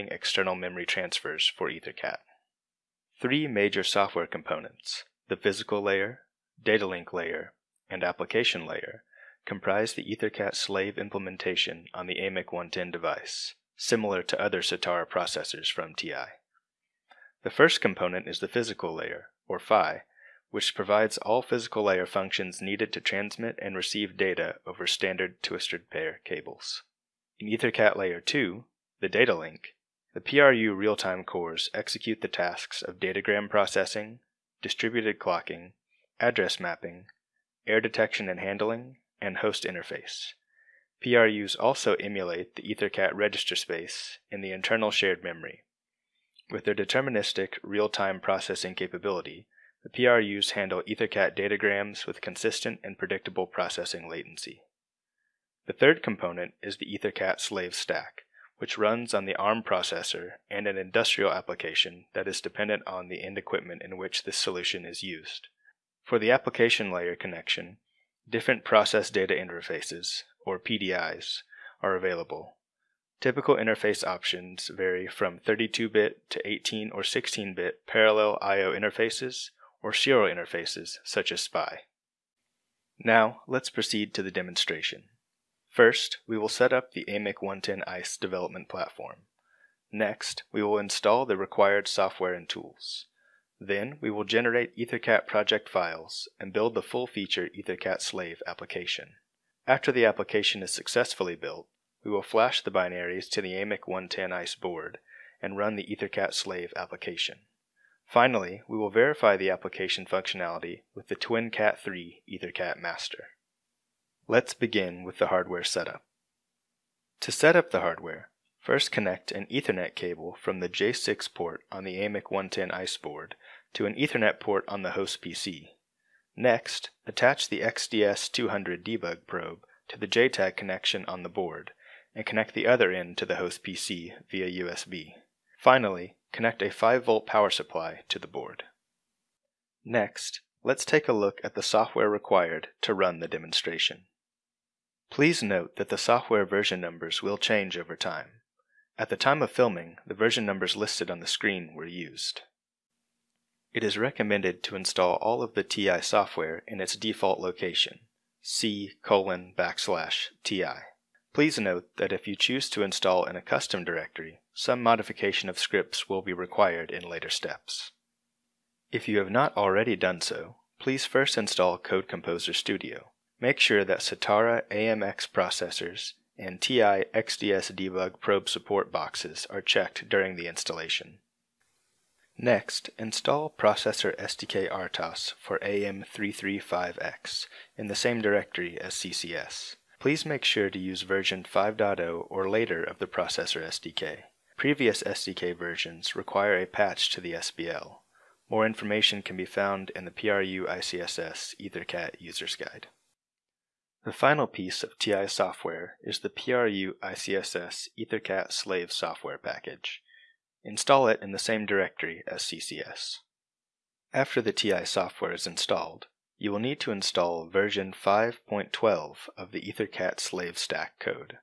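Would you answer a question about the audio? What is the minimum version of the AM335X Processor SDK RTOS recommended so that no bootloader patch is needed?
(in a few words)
5.0.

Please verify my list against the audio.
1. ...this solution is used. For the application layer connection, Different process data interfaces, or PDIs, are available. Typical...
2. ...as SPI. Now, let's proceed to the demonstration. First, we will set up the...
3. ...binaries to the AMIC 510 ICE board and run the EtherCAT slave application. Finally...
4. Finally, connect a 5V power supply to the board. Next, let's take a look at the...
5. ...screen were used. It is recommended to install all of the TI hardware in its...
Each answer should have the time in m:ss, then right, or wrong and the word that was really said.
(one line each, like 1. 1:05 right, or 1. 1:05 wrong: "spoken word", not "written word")
1. 1:04 right
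2. 1:21 right
3. 1:42 wrong: "110", not "510"
4. 2:15 right
5. 2:31 wrong: "software", not "hardware".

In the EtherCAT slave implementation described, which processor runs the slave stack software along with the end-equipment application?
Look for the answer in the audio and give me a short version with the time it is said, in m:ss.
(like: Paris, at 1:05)
ARM processor, at 0:59.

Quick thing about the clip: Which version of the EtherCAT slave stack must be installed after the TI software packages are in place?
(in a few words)
5.12.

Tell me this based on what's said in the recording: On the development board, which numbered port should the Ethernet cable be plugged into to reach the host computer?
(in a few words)
J6.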